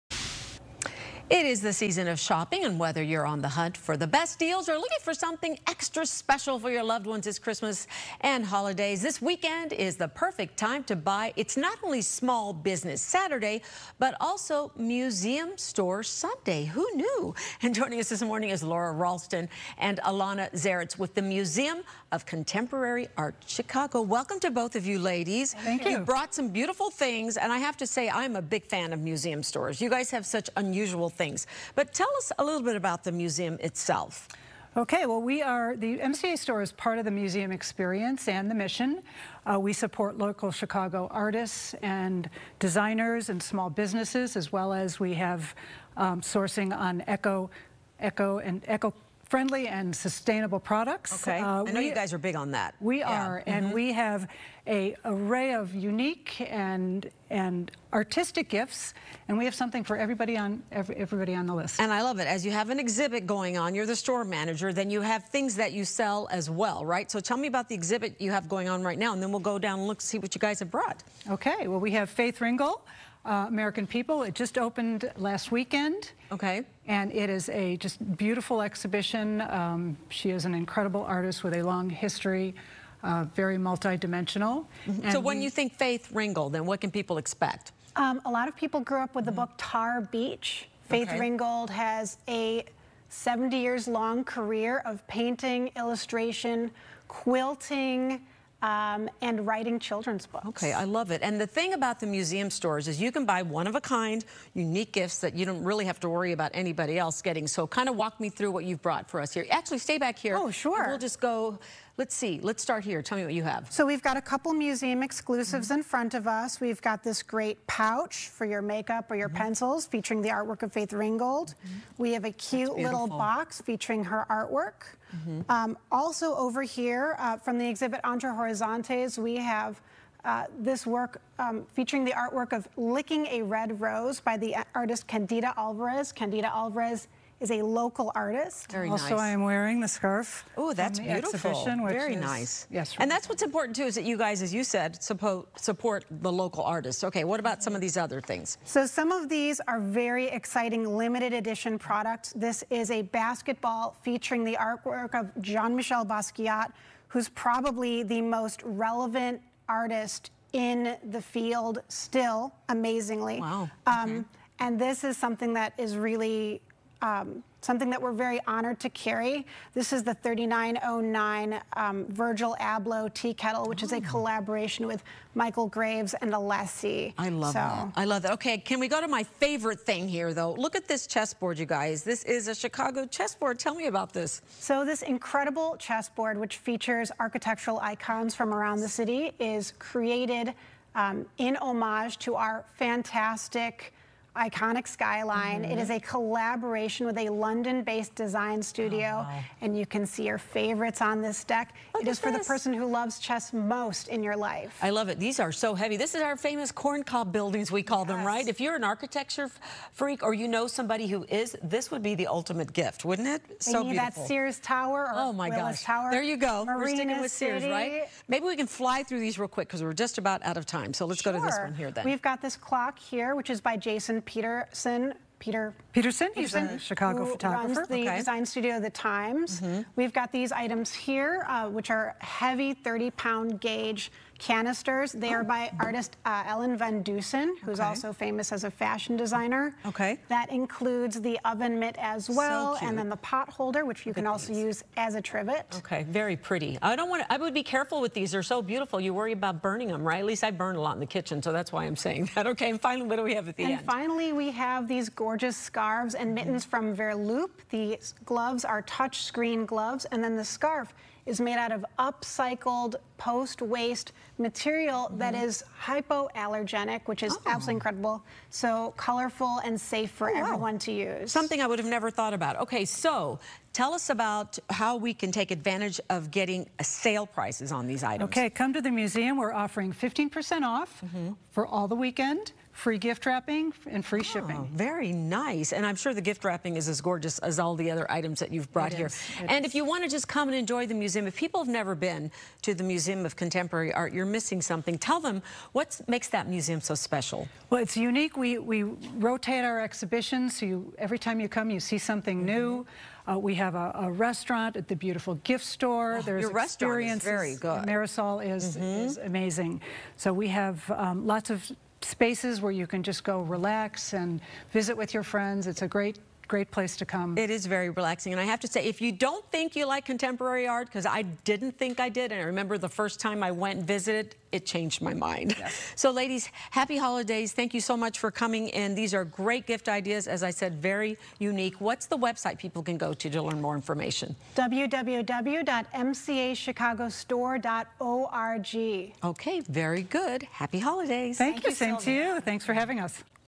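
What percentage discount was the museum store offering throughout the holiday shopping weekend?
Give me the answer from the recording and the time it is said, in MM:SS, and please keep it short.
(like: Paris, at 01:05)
15%, at 04:39.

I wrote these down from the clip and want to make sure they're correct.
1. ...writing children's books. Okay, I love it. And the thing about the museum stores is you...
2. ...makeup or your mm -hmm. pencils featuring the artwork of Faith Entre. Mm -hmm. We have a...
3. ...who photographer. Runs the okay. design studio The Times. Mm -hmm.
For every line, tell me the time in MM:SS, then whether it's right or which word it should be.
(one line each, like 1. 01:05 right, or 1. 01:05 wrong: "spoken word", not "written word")
1. 01:39 right
2. 01:58 wrong: "Ringgold", not "Entre"
3. 03:47 right.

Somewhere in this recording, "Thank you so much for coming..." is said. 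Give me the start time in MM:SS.
05:27.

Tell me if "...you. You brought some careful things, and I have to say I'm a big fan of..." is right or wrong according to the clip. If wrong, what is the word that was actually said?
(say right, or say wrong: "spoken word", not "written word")
wrong: "beautiful", not "careful".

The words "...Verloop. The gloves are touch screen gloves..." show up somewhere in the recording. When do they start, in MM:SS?
04:16.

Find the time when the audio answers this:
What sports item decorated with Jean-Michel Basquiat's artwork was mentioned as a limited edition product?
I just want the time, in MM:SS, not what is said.
02:33.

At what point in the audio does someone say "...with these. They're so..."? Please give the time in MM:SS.
04:08.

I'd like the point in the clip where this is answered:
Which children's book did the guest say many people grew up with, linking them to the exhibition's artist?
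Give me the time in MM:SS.
01:29.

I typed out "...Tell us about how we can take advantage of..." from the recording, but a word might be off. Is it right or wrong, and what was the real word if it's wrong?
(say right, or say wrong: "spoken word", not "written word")
right.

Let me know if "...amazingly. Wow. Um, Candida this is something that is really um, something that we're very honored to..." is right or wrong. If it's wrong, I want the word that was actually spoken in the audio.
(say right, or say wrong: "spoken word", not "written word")
wrong: "And", not "Candida".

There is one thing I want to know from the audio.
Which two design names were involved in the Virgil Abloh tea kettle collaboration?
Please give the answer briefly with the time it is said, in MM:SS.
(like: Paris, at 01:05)
Michael Graves and Alessi, at 02:55.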